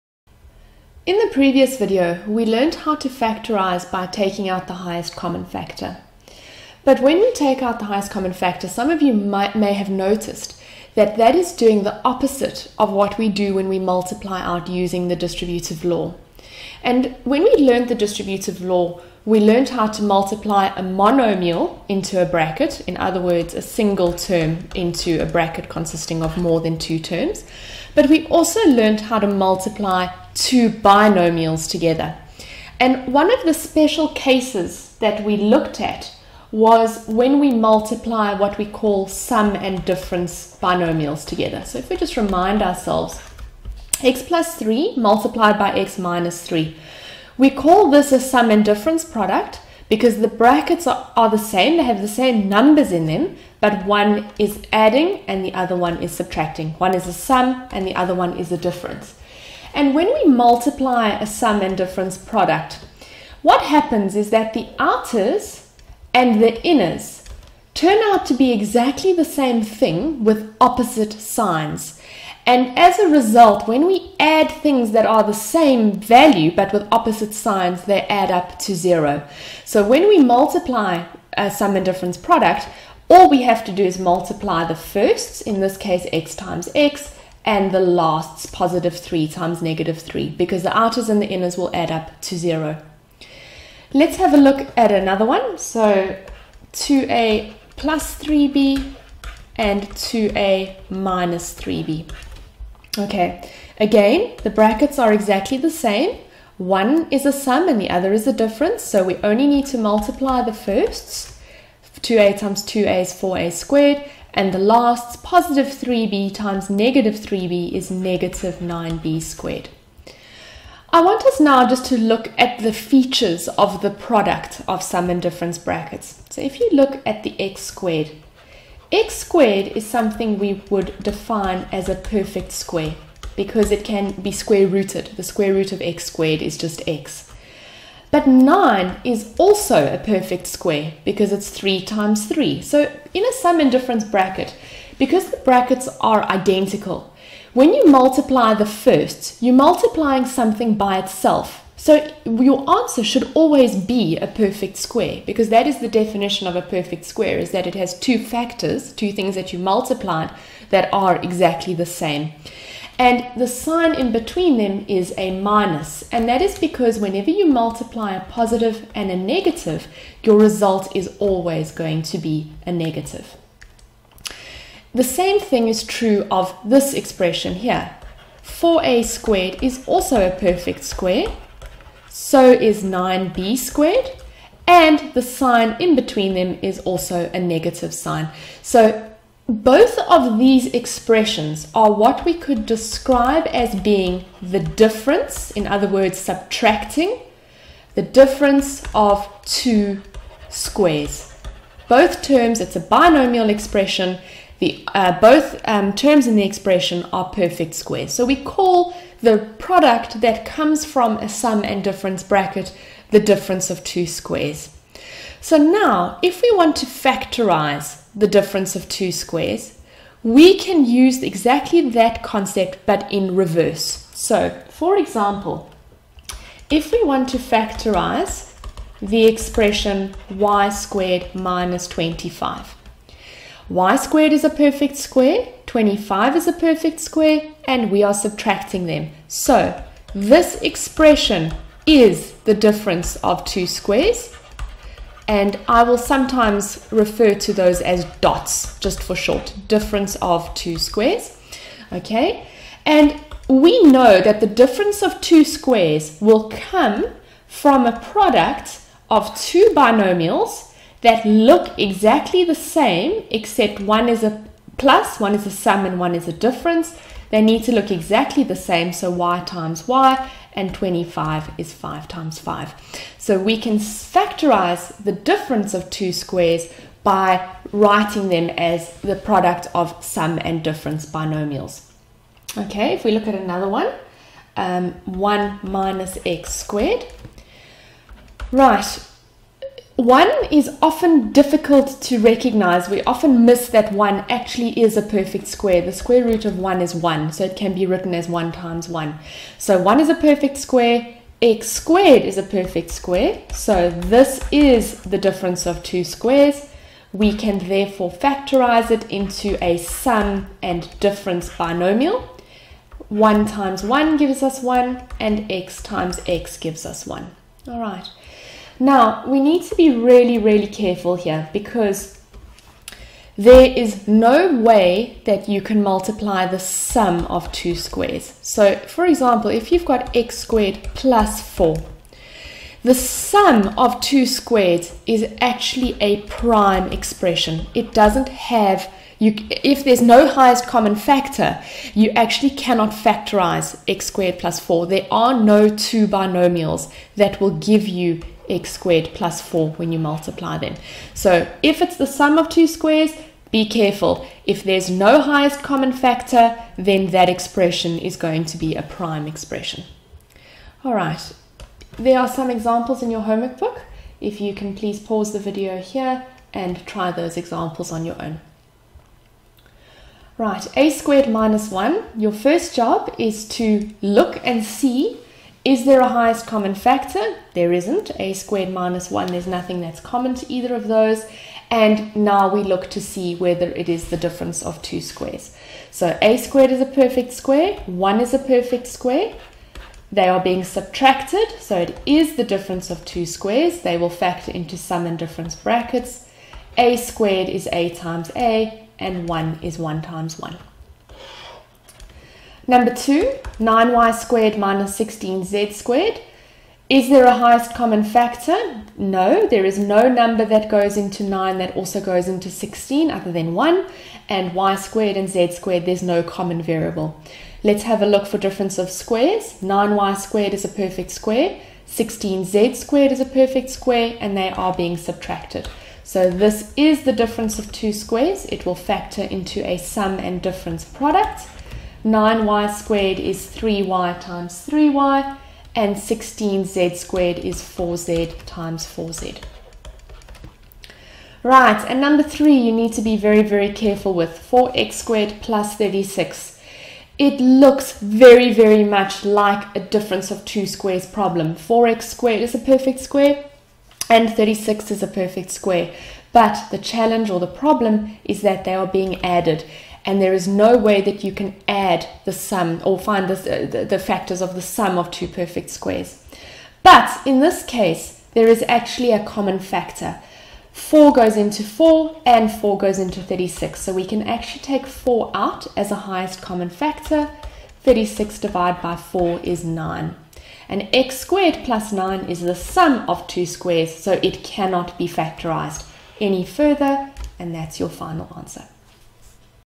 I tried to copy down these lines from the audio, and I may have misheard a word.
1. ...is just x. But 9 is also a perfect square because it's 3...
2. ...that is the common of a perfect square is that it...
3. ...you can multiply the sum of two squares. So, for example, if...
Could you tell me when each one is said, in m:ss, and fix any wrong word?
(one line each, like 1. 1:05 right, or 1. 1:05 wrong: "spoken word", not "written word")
1. 2:16 right
2. 2:35 wrong: "definition", not "common"
3. 5:25 right.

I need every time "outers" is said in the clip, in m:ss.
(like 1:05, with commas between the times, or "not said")
1:04, 1:30.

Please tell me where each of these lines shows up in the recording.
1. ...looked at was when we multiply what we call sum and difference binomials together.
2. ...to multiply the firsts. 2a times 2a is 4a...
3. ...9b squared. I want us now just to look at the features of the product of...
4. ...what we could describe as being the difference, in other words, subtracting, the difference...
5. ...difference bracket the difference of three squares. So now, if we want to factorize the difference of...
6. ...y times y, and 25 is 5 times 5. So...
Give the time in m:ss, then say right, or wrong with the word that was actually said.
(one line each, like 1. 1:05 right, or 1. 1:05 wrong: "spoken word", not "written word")
1. 0:35 right
2. 1:49 right
3. 1:58 right
4. 3:11 right
5. 3:31 wrong: "two", not "three"
6. 4:29 right.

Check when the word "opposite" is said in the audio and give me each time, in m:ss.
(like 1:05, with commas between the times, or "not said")
0:12, 1:10, 1:16.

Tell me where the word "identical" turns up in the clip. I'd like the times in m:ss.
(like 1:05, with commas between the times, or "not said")
2:26.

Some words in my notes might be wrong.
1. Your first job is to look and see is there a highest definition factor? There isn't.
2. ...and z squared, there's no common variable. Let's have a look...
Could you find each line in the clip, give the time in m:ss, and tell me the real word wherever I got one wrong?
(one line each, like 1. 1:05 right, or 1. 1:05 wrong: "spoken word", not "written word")
1. 6:12 wrong: "common", not "definition"
2. 6:55 right.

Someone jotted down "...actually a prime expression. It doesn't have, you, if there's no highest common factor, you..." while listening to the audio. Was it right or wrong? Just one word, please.
right.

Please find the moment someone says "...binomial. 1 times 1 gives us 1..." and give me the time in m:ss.
5:11.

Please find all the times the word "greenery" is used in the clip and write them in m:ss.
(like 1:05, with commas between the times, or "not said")
not said.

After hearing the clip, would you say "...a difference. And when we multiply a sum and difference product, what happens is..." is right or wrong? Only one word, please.
right.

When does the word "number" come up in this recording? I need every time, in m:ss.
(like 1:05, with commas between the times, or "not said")
0:52, 6:42, 6:50, 7:22.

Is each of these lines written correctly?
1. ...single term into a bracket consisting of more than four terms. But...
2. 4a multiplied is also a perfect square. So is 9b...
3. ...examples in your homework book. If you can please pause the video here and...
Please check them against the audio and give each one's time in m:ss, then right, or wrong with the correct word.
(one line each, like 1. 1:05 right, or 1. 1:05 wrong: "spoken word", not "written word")
1. 0:23 wrong: "two", not "four"
2. 2:58 wrong: "squared", not "multiplied"
3. 6:02 right.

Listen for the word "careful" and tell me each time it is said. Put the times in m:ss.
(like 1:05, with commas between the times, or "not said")
5:20, 5:53, 7:23.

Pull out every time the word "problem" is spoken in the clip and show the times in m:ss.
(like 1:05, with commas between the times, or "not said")
7:31, 7:37.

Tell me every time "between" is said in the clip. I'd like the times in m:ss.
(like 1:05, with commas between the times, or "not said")
2:44, 3:05.